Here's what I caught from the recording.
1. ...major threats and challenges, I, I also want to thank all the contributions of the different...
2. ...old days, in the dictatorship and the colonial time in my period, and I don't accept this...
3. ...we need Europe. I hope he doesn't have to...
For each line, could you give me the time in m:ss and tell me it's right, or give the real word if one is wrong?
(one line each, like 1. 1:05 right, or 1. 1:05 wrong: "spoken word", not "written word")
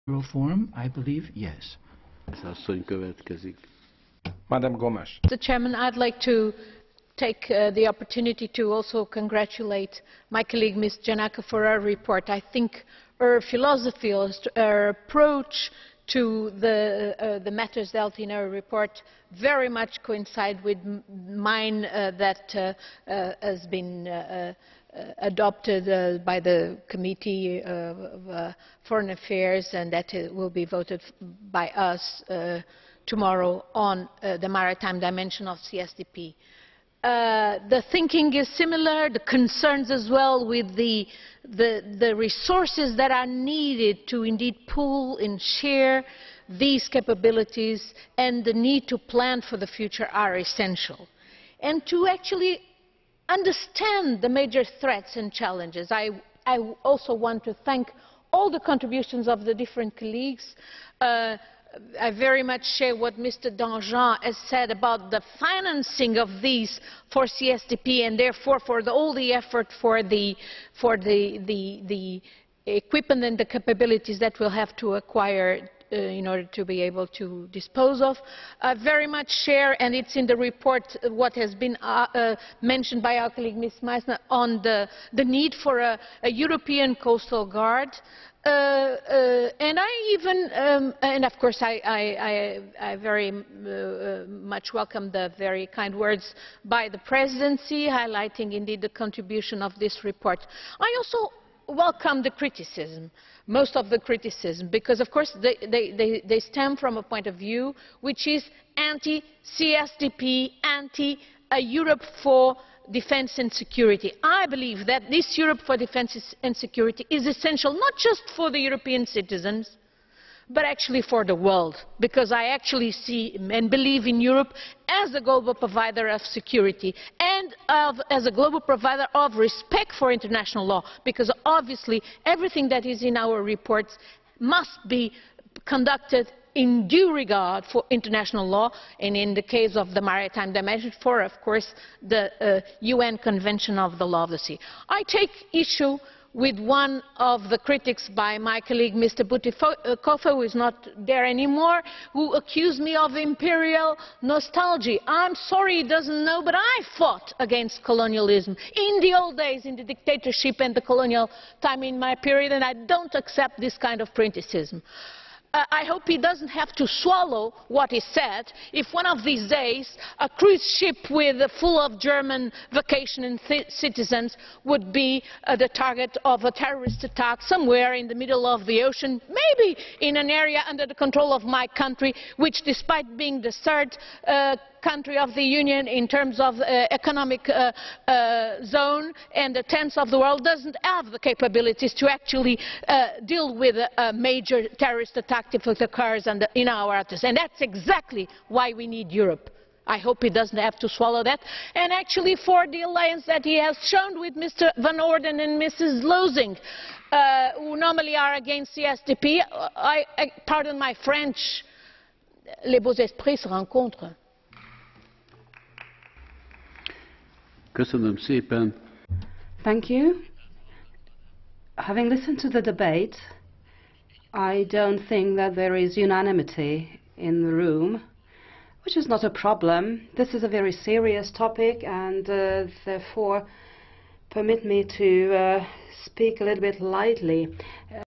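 1. 0:54 right
2. 2:39 right
3. 3:18 right.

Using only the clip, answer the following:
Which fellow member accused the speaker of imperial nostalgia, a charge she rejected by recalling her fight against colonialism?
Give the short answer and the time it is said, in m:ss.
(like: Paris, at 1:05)
Mr. Bütikofer, at 2:28.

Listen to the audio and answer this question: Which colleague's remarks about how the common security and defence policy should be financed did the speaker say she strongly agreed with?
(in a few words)
Mr. Danjean.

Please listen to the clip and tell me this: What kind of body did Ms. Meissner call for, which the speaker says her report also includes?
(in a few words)
European coastal guard.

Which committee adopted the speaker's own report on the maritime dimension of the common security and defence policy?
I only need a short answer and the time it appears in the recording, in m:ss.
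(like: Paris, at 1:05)
Committee of Foreign Affairs, at 0:26.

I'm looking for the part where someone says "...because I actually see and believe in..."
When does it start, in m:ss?
2:01.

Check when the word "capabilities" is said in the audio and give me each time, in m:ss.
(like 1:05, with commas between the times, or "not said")
0:46, 1:13, 3:11.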